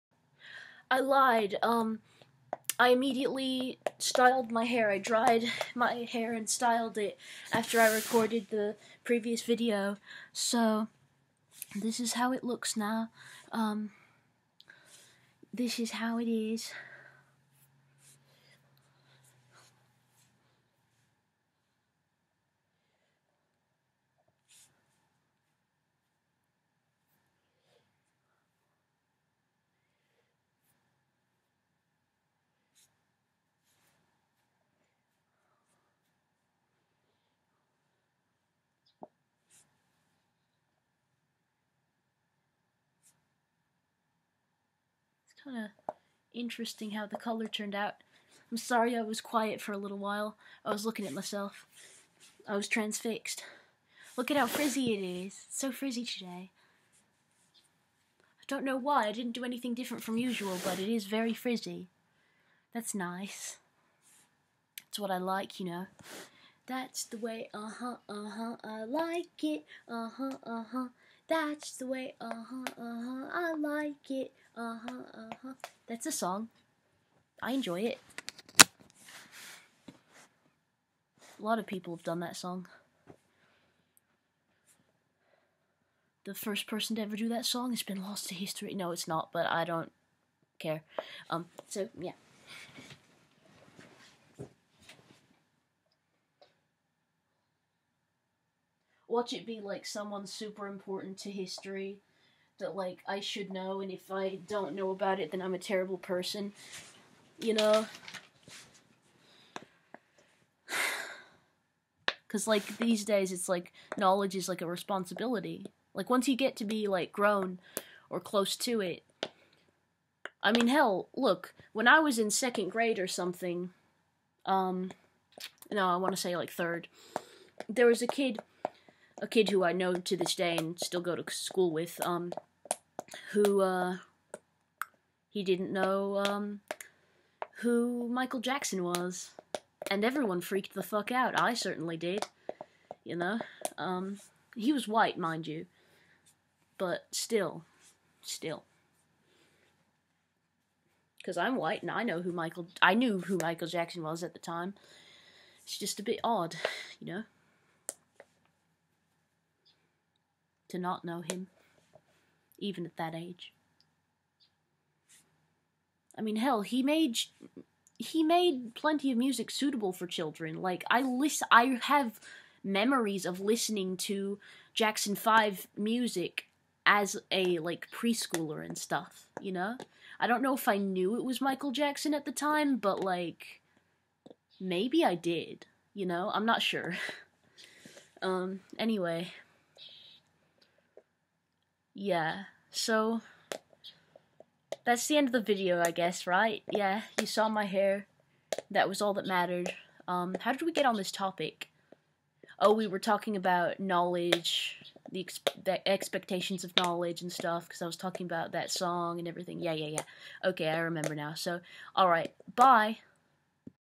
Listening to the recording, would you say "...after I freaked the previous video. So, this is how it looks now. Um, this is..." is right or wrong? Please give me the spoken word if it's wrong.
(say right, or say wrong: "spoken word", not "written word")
wrong: "recorded", not "freaked".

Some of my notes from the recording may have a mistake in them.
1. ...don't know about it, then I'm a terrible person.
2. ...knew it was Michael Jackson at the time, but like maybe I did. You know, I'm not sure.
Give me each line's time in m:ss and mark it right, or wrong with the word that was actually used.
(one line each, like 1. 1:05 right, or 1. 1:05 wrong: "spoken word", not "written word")
1. 1:44 right
2. 3:00 right.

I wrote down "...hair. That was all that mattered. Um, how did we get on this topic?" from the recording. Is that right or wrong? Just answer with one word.
right.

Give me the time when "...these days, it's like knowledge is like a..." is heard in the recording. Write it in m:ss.
1:52.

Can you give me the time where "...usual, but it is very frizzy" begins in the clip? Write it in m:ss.
1:00.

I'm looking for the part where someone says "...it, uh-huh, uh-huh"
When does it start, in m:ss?
1:09.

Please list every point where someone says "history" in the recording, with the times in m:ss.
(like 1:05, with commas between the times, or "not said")
1:28, 1:41.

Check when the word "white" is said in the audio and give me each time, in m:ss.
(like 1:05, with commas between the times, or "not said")
2:24, 2:31.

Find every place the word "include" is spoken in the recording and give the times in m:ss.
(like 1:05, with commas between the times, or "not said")
not said.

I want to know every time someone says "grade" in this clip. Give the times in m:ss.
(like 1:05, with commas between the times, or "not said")
2:02.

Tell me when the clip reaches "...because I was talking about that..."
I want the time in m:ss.
3:27.